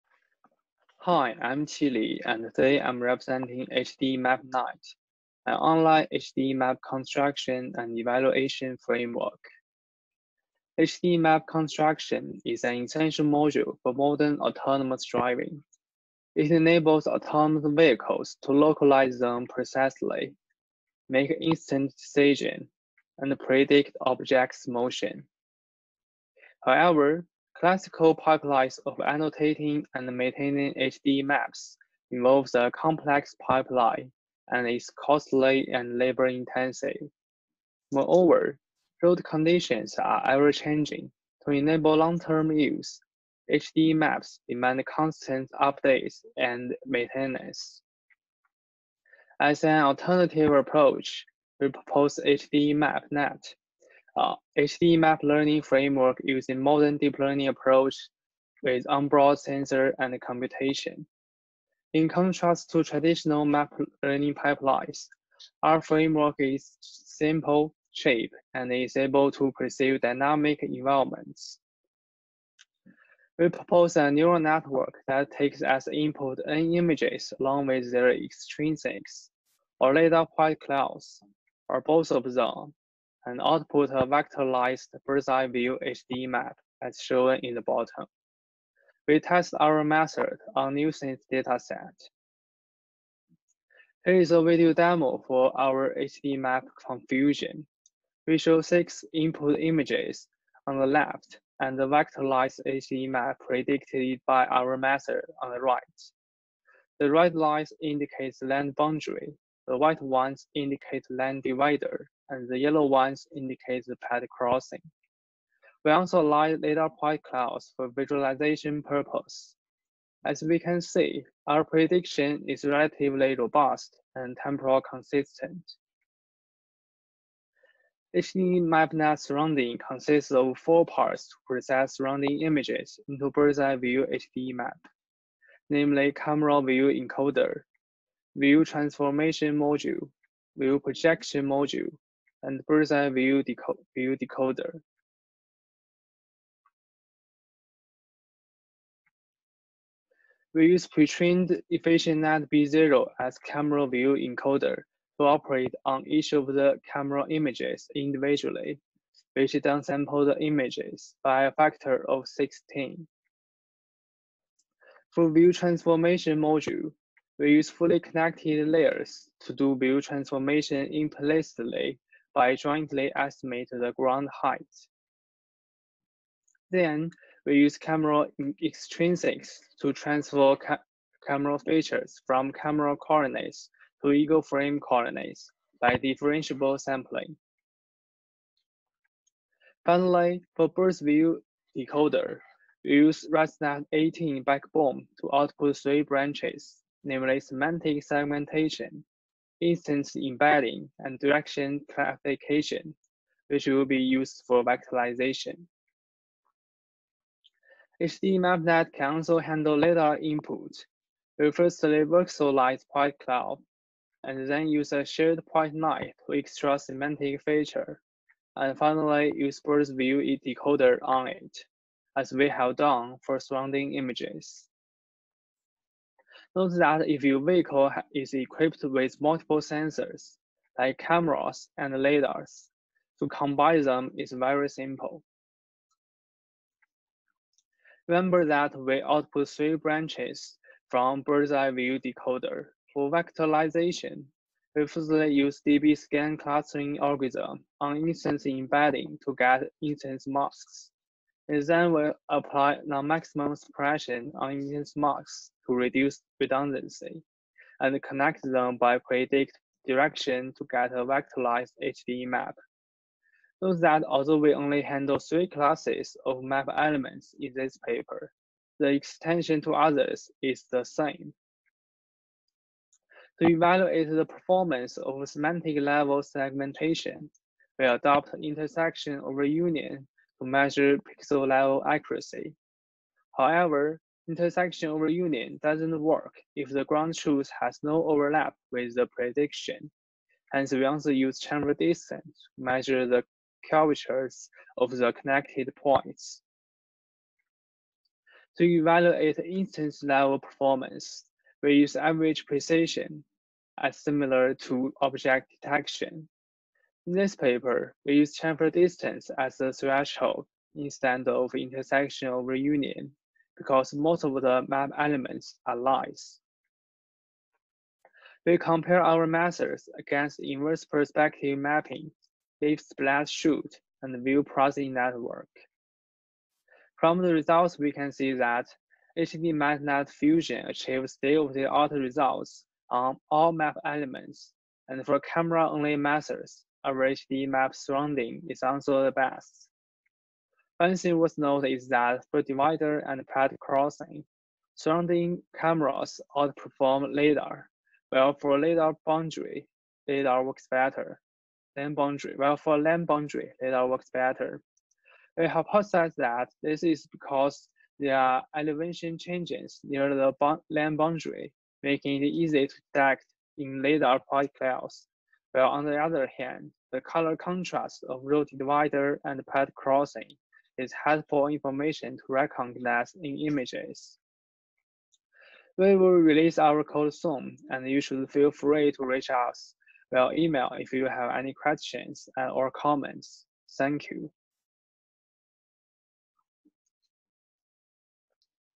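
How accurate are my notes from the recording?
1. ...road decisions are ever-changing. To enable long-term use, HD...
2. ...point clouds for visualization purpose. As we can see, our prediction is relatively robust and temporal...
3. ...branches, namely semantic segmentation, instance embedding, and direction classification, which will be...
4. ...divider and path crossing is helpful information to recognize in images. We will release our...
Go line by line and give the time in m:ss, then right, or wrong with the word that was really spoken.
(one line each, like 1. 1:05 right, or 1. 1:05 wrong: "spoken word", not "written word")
1. 0:39 wrong: "conditions", not "decisions"
2. 1:56 right
3. 3:16 right
4. 6:08 right.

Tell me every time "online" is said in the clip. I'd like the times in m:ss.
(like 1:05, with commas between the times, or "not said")
0:05.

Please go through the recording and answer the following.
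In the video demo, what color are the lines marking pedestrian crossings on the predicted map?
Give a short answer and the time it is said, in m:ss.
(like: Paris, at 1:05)
Yellow, at 1:52.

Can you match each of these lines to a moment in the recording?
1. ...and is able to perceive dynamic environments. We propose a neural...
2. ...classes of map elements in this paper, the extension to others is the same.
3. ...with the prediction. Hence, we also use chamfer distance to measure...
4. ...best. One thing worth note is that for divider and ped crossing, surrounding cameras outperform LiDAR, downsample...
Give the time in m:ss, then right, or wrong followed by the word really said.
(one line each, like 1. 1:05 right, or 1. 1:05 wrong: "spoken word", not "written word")
1. 1:08 right
2. 4:25 right
3. 4:48 right
4. 5:39 wrong: "while", not "downsample".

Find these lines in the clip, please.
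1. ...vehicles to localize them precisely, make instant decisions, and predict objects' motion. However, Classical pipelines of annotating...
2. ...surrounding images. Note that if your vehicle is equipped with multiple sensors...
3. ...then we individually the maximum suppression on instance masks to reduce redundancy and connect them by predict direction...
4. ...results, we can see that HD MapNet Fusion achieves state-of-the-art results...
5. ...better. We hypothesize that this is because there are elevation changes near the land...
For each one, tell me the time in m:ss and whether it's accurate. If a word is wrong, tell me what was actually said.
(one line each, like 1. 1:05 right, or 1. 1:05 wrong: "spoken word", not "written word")
1. 0:17 right
2. 3:43 right
3. 4:11 wrong: "apply", not "individually"
4. 5:27 right
5. 5:54 right.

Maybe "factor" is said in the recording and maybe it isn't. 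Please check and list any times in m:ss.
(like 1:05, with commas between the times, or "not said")
2:41.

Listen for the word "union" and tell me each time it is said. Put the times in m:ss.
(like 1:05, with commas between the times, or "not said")
4:39, 4:45, 5:12.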